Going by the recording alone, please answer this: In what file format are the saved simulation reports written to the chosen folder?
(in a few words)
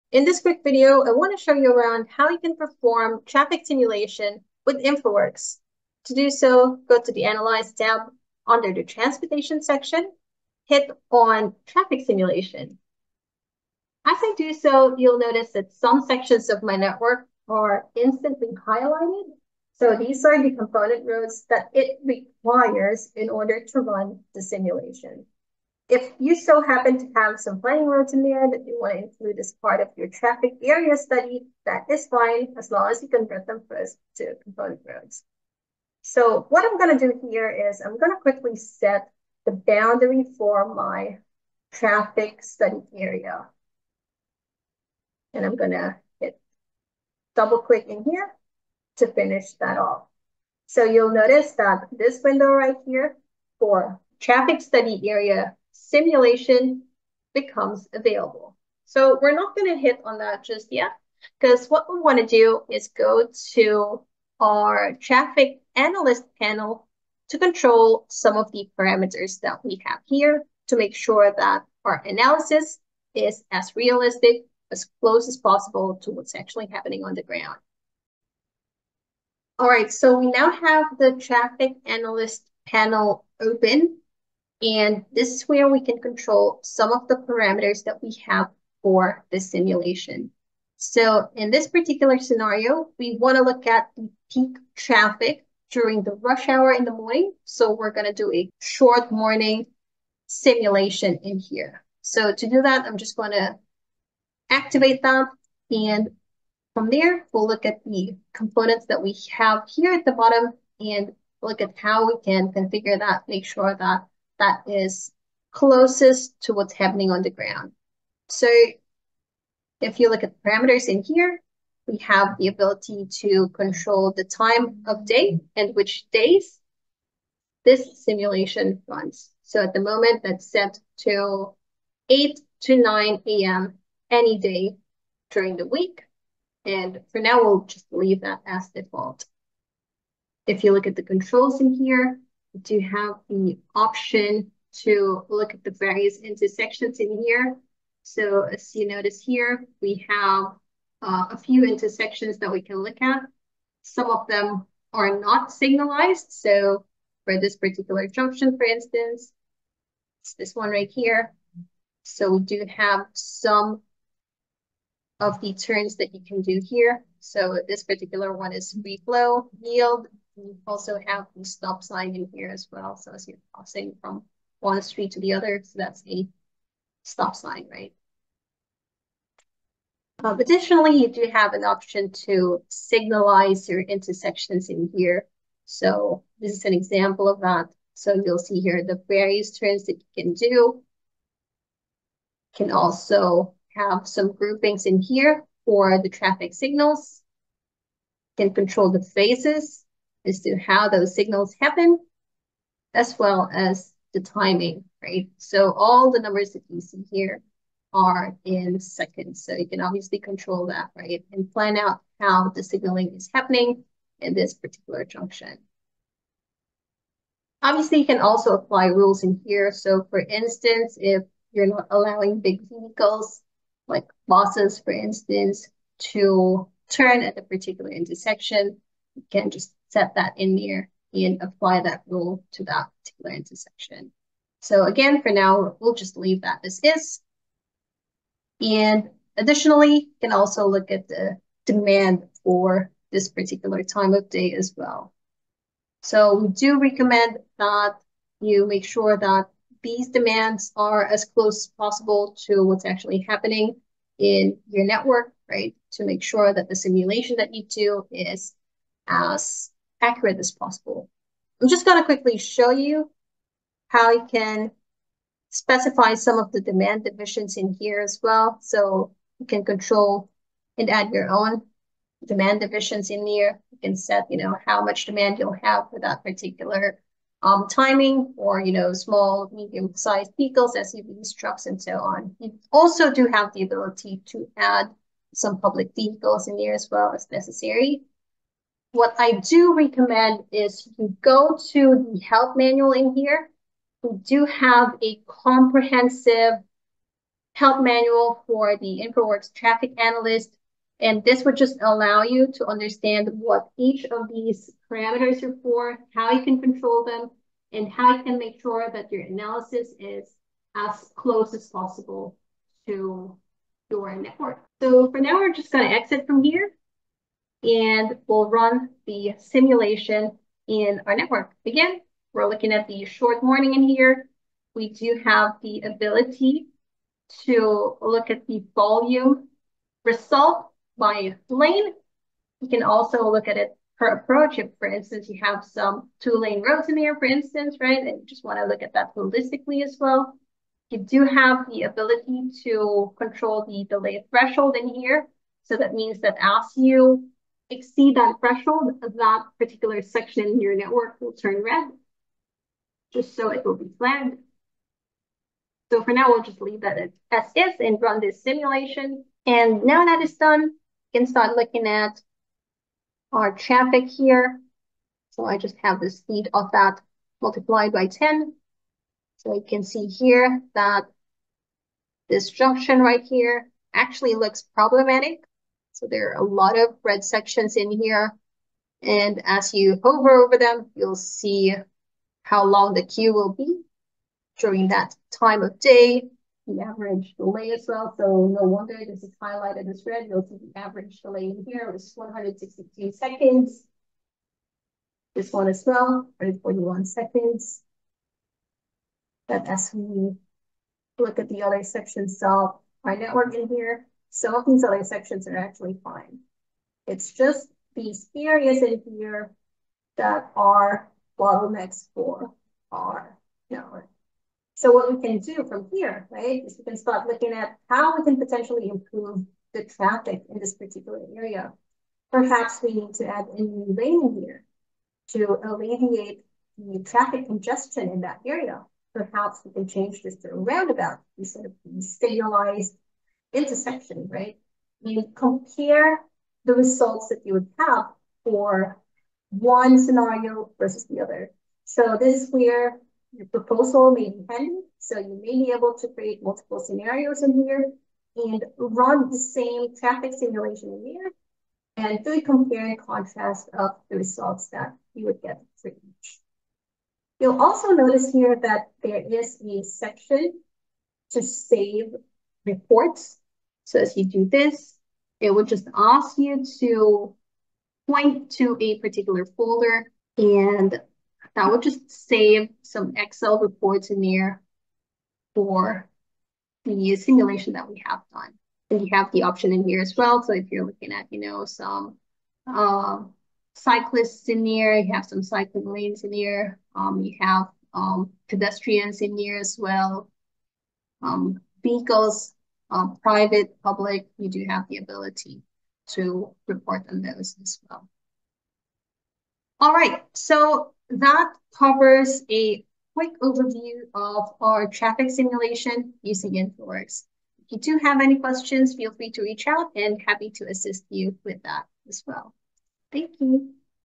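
Excel.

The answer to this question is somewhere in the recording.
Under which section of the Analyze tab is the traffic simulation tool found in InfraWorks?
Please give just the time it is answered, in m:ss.
0:08.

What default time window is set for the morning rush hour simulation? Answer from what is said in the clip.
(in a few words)
8 to 9 a.m.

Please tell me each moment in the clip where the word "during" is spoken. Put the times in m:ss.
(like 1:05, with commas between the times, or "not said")
1:35, 2:15, 6:24.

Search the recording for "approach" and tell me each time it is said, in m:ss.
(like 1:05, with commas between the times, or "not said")
5:34.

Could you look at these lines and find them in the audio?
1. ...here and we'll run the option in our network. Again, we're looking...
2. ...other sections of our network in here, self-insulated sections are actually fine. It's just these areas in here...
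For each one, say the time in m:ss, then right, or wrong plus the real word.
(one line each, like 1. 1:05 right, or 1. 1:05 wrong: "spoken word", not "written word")
1. 5:16 wrong: "simulation", not "option"
2. 6:41 right.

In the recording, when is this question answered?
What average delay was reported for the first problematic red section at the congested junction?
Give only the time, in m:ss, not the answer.
6:32.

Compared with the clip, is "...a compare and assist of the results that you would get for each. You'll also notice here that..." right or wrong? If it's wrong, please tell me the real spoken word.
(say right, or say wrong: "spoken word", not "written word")
wrong: "contrast", not "assist".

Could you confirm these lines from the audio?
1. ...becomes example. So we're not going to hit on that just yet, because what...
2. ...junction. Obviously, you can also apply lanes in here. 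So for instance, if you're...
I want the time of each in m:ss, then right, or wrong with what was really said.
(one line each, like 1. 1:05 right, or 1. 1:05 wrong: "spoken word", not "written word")
1. 0:57 wrong: "available", not "example"
2. 3:35 wrong: "rules", not "lanes".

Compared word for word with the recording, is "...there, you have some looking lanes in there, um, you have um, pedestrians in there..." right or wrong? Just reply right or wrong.
wrong.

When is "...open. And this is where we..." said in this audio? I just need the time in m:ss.
1:23.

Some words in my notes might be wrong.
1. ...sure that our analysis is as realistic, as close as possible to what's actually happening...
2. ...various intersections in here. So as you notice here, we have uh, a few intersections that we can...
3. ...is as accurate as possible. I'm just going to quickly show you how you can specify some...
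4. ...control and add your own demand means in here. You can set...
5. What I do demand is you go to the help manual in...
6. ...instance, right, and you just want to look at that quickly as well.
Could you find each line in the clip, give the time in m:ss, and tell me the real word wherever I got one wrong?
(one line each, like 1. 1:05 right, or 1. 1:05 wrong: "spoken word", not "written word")
1. 1:10 right
2. 2:25 right
3. 4:18 right
4. 4:29 wrong: "divisions", not "means"
5. 4:48 wrong: "recommend", not "demand"
6. 5:37 wrong: "holistically", not "quickly".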